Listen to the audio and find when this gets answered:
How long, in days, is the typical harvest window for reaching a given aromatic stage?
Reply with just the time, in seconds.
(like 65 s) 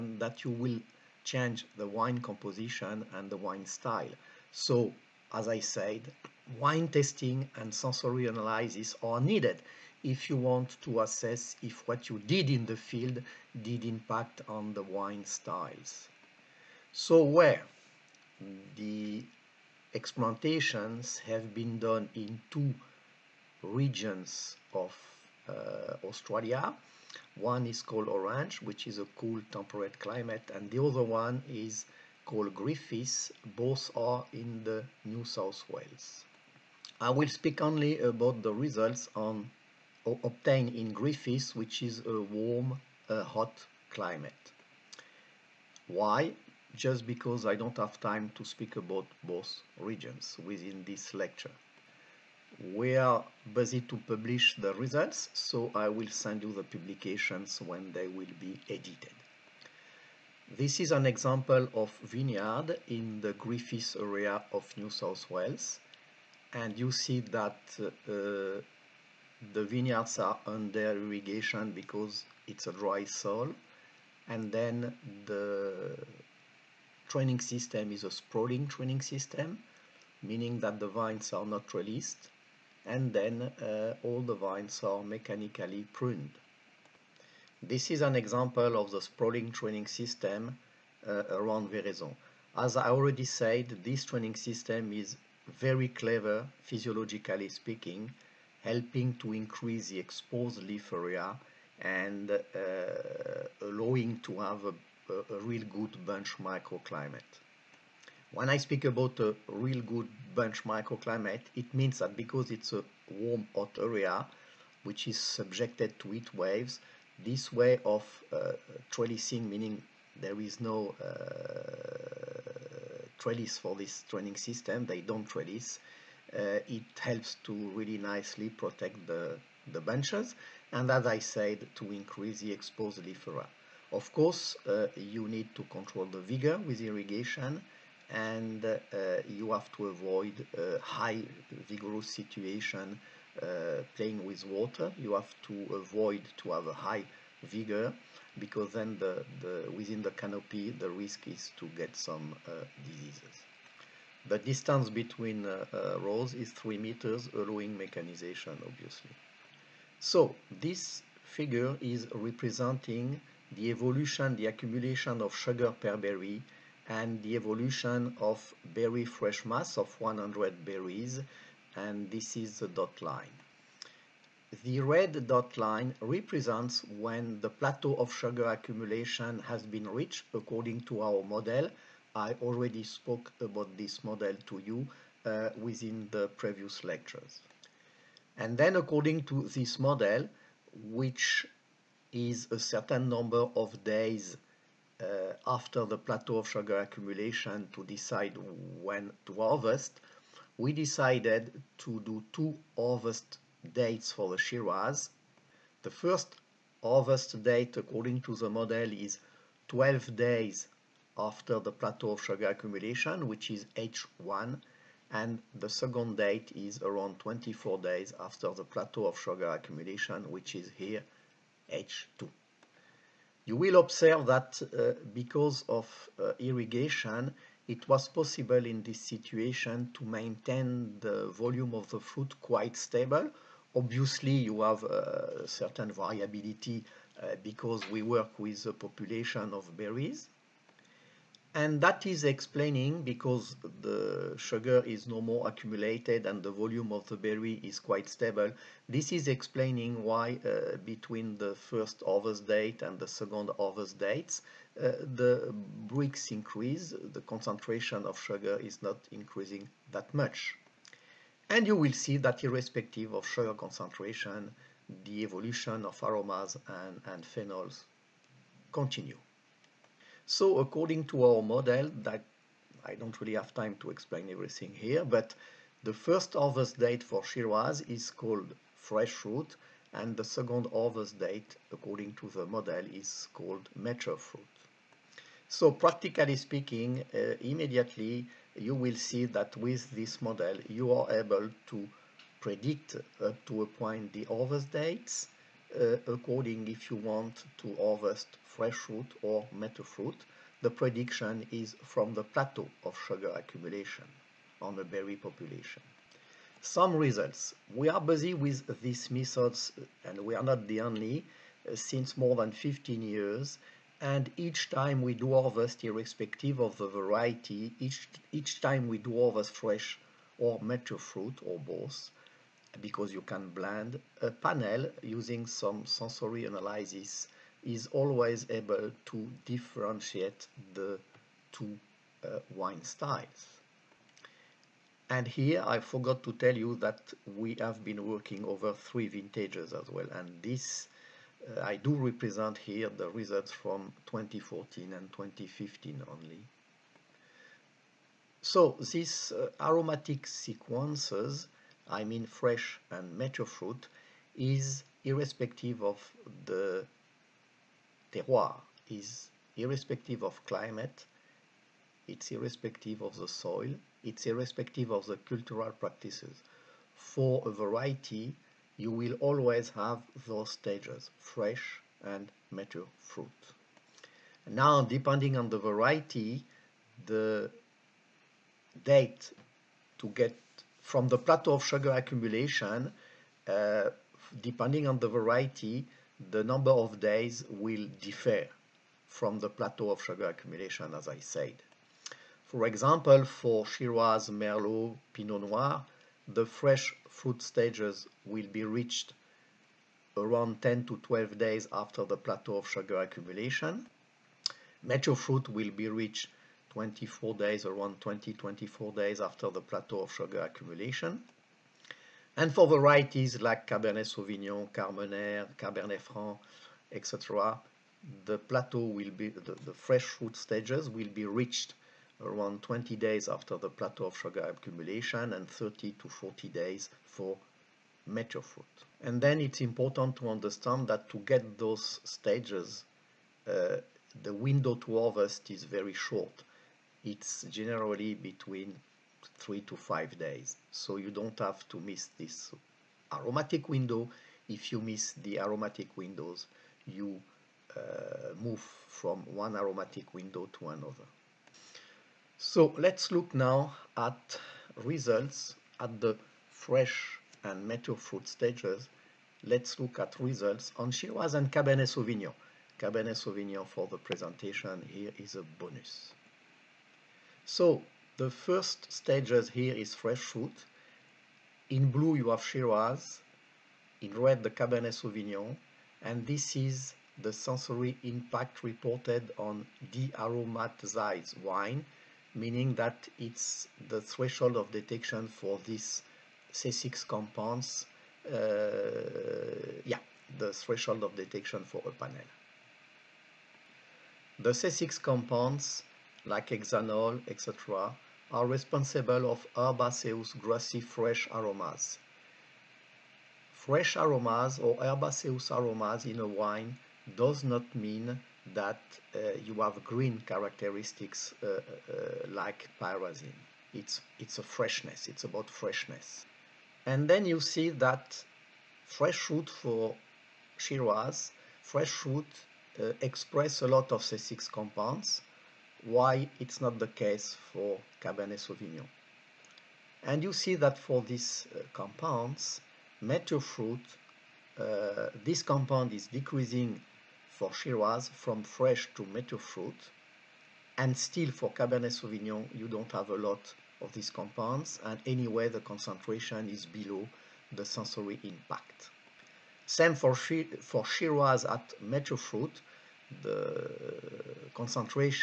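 439 s.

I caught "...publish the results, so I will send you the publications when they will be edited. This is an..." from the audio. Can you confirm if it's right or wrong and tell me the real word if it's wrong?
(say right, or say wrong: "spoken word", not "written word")
right.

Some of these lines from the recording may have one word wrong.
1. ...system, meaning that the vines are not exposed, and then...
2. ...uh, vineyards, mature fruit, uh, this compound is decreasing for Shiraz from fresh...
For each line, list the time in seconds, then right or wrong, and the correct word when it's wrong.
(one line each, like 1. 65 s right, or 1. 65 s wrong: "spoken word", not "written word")
1. 79 s wrong: "released", not "exposed"
2. 531 s wrong: "compounds", not "vineyards".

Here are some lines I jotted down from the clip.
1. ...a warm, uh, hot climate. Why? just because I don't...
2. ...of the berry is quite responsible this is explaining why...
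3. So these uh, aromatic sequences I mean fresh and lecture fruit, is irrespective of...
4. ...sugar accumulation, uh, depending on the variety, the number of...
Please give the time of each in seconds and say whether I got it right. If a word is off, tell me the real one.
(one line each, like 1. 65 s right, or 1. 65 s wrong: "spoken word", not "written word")
1. 42 s right
2. 246 s wrong: "stable", not "responsible"
3. 348 s wrong: "mature", not "lecture"
4. 381 s right.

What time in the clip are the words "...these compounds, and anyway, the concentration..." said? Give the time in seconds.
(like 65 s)
543 s.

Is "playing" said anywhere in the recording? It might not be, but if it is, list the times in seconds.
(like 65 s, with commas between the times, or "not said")
143 s.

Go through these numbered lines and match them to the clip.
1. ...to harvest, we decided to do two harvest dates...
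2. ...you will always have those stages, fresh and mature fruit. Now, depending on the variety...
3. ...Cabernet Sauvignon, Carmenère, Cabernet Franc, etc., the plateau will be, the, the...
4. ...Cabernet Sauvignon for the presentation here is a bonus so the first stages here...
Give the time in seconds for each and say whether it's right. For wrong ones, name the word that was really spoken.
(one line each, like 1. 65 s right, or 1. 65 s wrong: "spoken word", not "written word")
1. 199 s right
2. 368 s right
3. 413 s right
4. 462 s right.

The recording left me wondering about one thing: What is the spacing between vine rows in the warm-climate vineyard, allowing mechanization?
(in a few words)
3 meters.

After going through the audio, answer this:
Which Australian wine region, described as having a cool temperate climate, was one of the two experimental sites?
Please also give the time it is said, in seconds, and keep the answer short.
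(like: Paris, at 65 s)
Orange, at 28 s.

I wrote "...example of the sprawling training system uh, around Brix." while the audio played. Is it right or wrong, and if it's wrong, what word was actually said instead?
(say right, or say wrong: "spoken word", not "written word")
wrong: "Veraison", not "Brix".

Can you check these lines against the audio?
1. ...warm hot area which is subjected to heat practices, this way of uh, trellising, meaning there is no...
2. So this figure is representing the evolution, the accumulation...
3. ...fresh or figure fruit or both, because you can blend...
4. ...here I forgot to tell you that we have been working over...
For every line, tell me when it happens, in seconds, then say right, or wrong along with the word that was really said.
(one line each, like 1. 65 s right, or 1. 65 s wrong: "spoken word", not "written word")
1. 113 s wrong: "waves", not "practices"
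2. 159 s right
3. 319 s wrong: "mature", not "figure"
4. 335 s right.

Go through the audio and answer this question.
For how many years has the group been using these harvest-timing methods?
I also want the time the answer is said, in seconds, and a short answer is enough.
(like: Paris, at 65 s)
more than 15 years, at 312 s.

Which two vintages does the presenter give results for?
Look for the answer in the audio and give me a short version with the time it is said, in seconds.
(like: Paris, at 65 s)
2014 and 2015, at 344 s.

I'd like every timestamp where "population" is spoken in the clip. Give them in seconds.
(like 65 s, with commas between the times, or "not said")
238 s, 305 s.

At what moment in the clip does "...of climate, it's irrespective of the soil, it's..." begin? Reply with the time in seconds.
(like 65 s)
360 s.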